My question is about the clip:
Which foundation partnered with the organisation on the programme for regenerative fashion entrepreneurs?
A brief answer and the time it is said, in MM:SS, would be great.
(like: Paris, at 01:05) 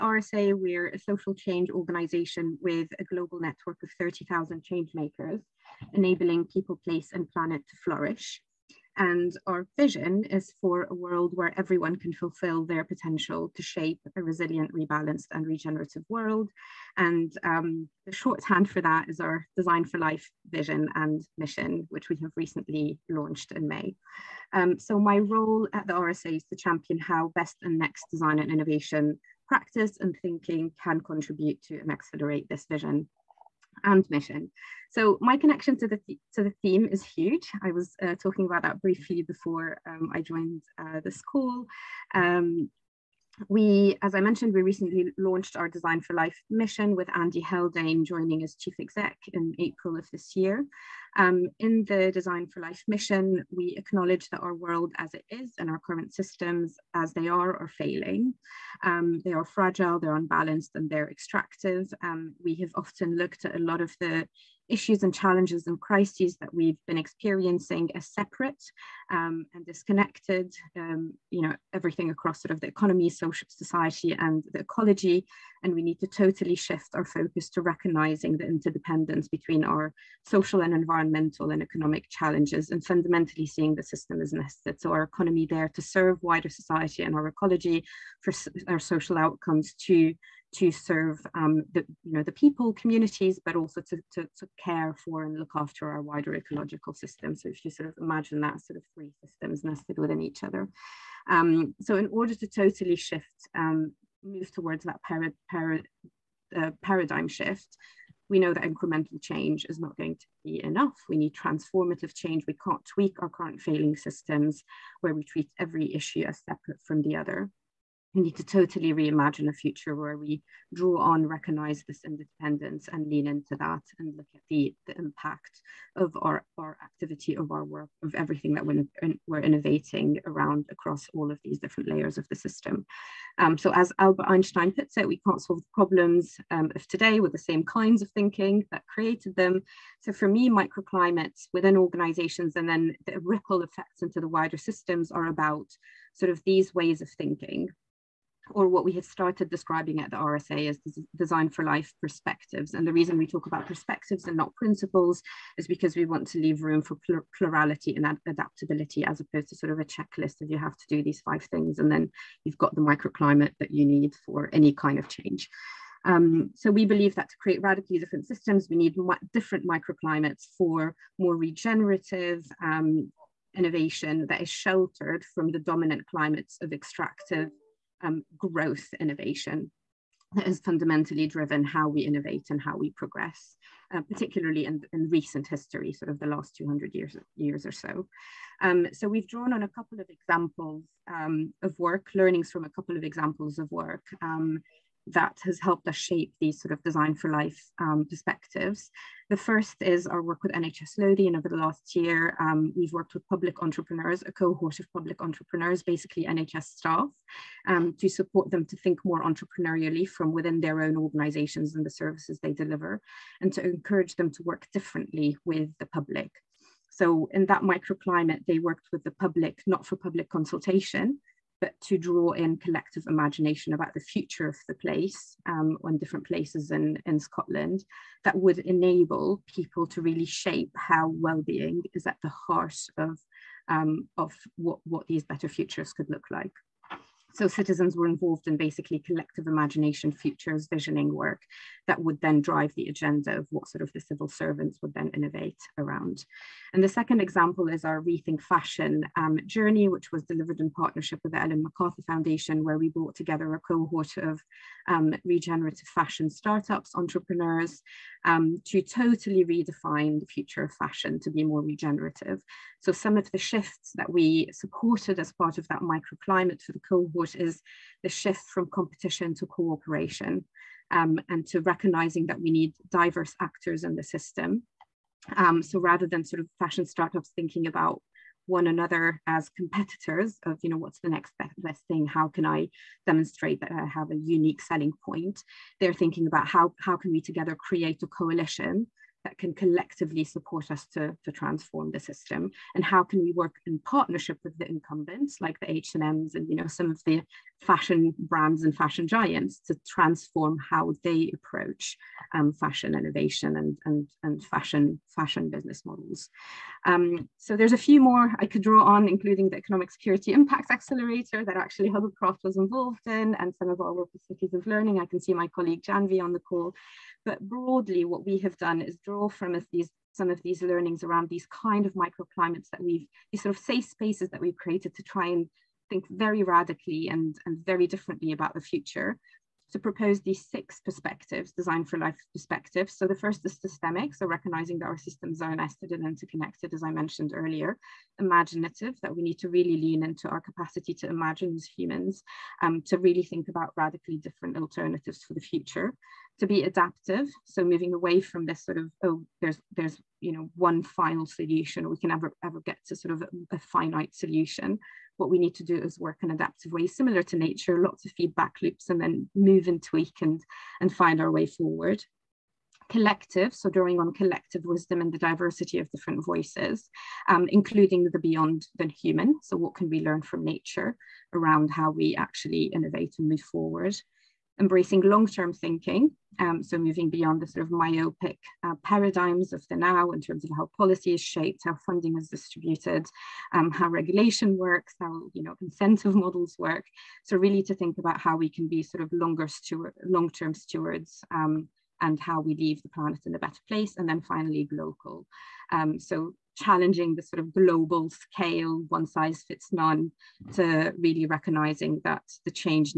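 Ellen MacArthur Foundation, at 04:11.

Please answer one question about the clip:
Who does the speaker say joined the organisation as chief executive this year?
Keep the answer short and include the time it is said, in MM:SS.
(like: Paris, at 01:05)
Andy Haldane, at 00:47.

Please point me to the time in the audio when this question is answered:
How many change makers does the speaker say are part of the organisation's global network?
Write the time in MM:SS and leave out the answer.
00:03.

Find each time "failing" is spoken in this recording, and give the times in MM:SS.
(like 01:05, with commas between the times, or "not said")
00:57, 01:53.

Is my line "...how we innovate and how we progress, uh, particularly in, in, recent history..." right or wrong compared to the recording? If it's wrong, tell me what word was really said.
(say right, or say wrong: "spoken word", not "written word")
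right.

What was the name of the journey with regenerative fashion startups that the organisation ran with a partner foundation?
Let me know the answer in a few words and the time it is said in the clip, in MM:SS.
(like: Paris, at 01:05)
Rethink Fashion, at 04:08.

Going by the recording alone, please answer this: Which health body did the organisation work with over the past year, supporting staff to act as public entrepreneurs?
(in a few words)
NHS Lothian.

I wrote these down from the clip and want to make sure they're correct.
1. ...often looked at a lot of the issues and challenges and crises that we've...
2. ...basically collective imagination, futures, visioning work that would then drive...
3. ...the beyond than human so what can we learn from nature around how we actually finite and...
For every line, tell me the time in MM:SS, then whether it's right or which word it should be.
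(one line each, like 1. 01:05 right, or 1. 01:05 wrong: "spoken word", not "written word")
1. 01:02 right
2. 03:58 right
3. 06:08 wrong: "innovate", not "finite".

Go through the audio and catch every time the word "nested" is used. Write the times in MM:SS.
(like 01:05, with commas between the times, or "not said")
01:24, 01:39, 05:35.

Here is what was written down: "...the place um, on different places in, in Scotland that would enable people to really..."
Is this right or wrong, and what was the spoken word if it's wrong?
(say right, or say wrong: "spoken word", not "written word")
right.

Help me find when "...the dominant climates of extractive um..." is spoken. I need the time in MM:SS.
02:55.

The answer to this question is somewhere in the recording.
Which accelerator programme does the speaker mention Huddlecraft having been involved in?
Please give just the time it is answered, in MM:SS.
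05:09.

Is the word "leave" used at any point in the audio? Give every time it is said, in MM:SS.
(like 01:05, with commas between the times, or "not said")
02:36, 06:32.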